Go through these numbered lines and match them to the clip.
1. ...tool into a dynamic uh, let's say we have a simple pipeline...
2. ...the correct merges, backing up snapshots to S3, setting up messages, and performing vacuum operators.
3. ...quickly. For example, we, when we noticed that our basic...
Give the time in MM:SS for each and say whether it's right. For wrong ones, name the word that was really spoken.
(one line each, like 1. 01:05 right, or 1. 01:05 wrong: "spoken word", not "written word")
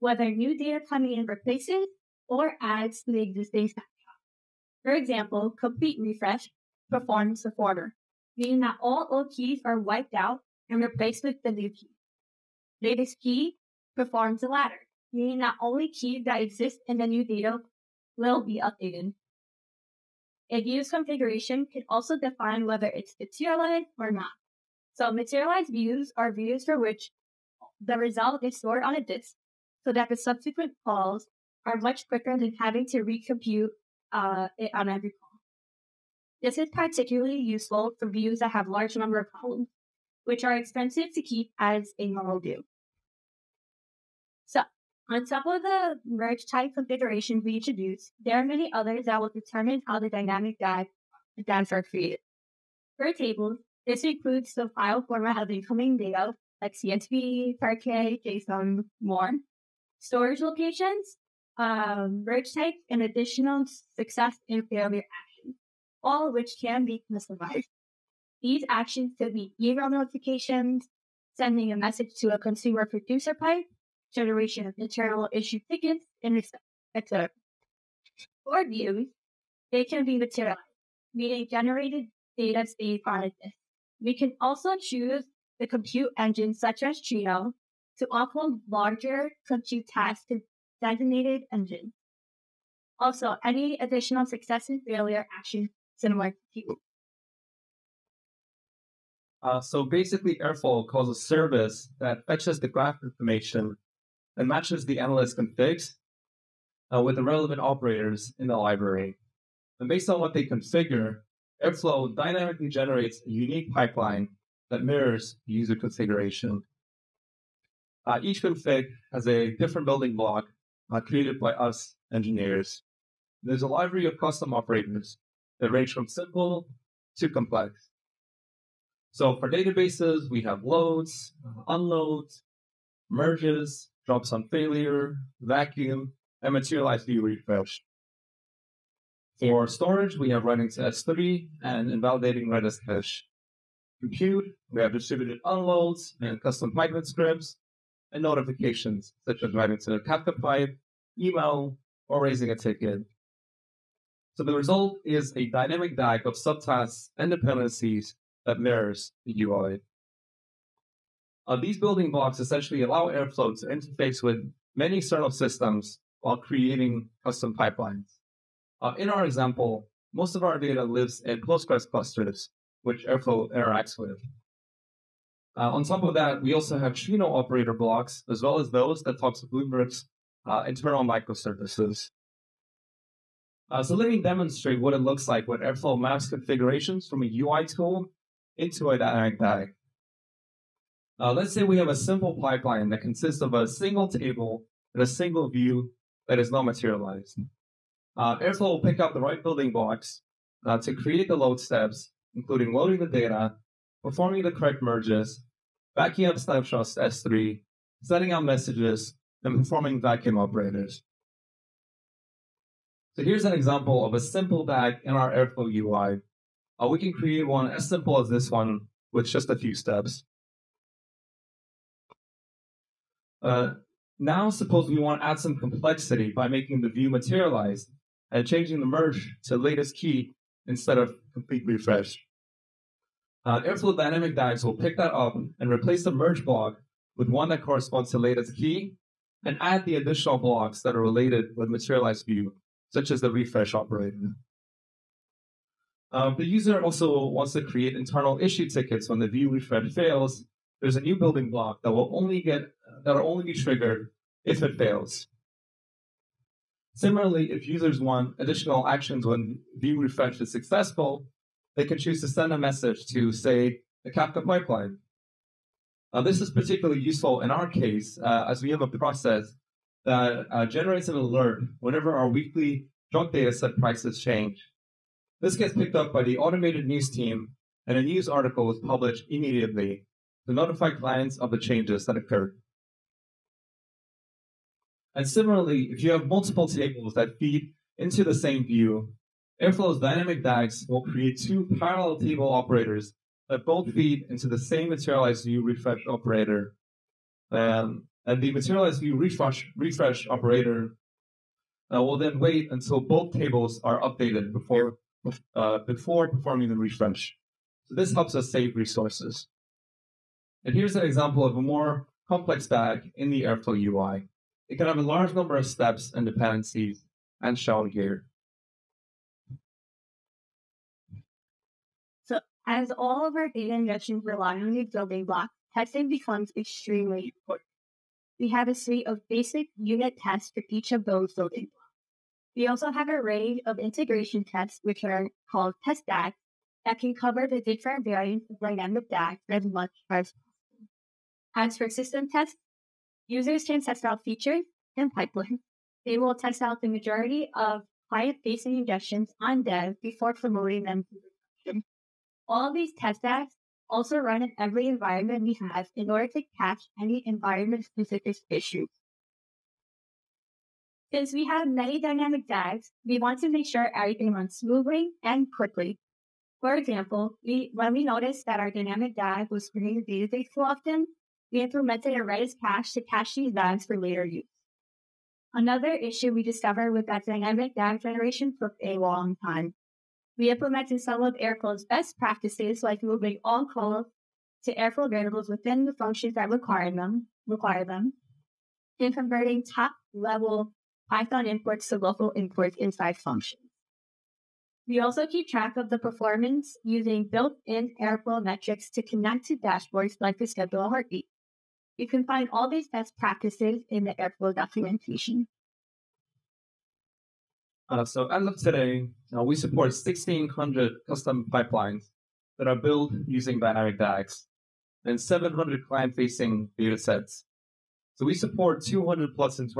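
1. 03:07 right
2. 03:24 right
3. 06:05 wrong: "dynamic", not "basic".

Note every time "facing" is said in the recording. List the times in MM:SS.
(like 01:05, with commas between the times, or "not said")
05:48, 06:55.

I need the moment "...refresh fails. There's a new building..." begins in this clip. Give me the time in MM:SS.
04:09.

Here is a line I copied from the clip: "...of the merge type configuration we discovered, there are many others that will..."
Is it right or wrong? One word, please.
wrong.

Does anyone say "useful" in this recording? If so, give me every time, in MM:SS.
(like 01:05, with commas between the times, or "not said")
00:37, 04:27.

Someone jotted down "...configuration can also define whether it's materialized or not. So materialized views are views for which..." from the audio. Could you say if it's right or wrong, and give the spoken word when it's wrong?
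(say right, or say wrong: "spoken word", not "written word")
right.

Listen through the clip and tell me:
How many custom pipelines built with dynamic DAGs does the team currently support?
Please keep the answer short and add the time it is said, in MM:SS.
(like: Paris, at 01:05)
1,600, at 06:49.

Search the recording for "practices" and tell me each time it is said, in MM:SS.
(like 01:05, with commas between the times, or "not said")
06:22, 06:43.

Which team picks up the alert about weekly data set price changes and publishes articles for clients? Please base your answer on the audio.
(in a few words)
automated news team.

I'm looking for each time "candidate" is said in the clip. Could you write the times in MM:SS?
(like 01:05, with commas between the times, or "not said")
not said.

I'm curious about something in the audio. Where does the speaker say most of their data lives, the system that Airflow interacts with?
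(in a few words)
Postgres clusters.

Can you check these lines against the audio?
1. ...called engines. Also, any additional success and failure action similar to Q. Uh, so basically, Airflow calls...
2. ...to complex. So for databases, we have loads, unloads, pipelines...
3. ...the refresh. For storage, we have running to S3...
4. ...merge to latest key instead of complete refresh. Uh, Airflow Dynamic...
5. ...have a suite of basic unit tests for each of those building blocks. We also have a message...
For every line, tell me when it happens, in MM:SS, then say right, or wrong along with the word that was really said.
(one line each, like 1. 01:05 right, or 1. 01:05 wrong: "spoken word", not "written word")
1. 01:30 wrong: "designated", not "called"
2. 02:07 wrong: "merges", not "pipelines"
3. 02:17 right
4. 03:48 right
5. 05:28 wrong: "range", not "message".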